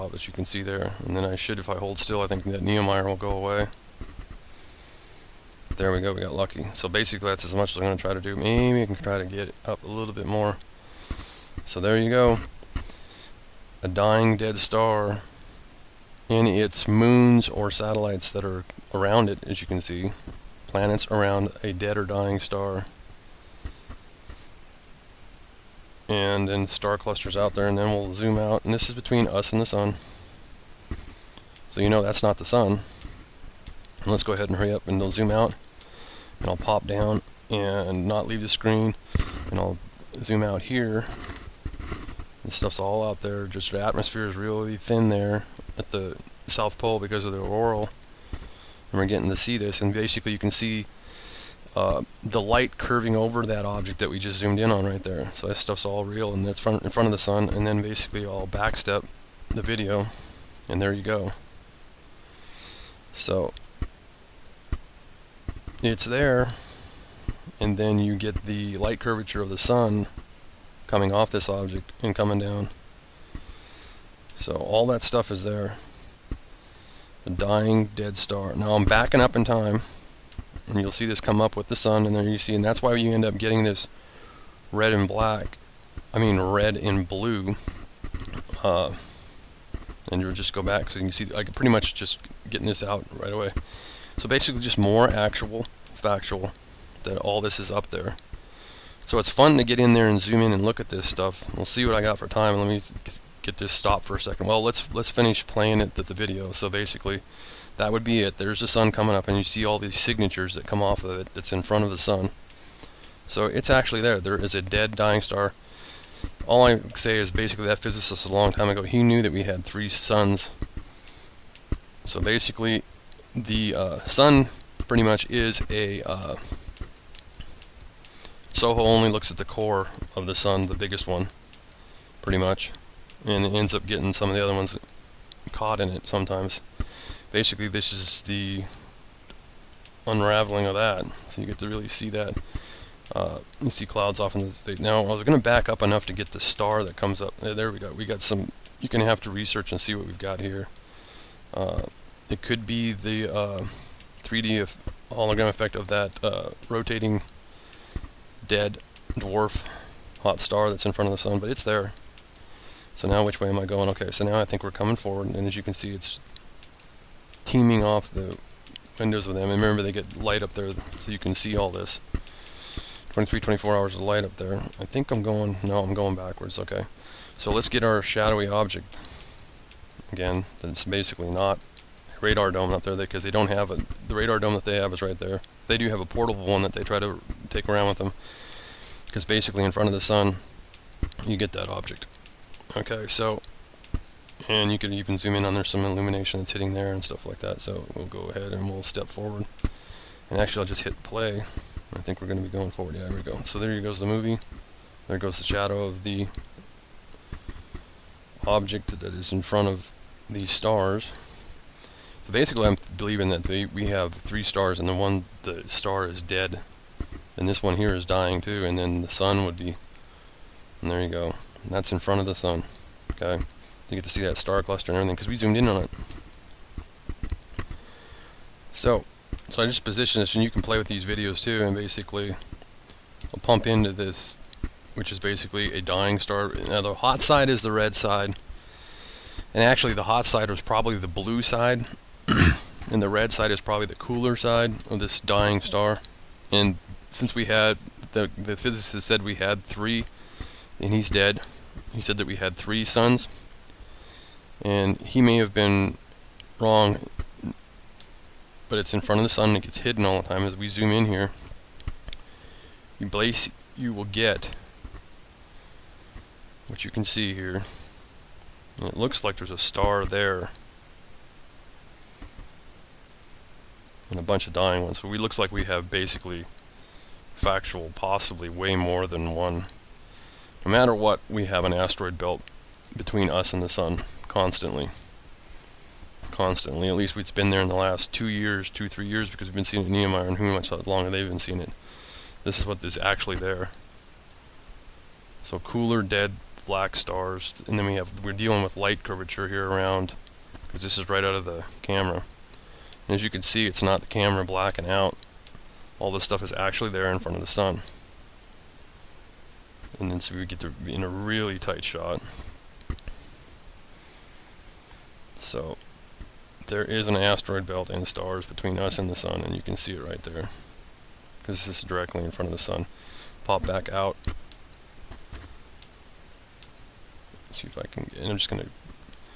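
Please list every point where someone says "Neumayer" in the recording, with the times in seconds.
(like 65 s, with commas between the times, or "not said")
2 s, 289 s.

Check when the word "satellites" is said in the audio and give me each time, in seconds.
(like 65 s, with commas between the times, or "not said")
17 s.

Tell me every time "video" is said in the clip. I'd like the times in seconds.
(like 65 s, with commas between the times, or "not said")
59 s, 106 s, 231 s.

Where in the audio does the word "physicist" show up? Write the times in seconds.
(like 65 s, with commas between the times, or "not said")
117 s, 248 s.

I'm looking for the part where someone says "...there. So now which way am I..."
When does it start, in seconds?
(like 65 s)
161 s.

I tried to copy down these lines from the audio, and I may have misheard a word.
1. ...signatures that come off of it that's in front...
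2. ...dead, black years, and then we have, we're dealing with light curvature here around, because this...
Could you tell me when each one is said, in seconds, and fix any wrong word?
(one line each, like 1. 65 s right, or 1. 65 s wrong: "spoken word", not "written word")
1. 109 s right
2. 296 s wrong: "stars", not "years".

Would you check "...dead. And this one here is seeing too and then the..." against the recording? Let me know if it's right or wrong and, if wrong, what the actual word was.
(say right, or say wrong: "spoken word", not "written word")
wrong: "dying", not "seeing".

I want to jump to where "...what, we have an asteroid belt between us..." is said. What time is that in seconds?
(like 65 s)
280 s.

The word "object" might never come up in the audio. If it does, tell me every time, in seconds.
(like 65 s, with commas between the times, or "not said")
53 s, 71 s, 178 s, 191 s, 208 s.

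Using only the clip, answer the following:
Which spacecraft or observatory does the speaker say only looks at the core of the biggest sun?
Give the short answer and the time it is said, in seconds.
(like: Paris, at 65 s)
SOHO, at 128 s.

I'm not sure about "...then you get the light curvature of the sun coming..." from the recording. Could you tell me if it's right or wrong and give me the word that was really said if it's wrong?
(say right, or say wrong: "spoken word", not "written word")
right.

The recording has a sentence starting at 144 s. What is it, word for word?
Now, I was going to back up enough to get the star that comes up.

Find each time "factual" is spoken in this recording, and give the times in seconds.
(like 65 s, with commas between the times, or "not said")
95 s, 277 s.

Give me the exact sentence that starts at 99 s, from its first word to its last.
So it's fun to get in there and zoom in and look at this stuff.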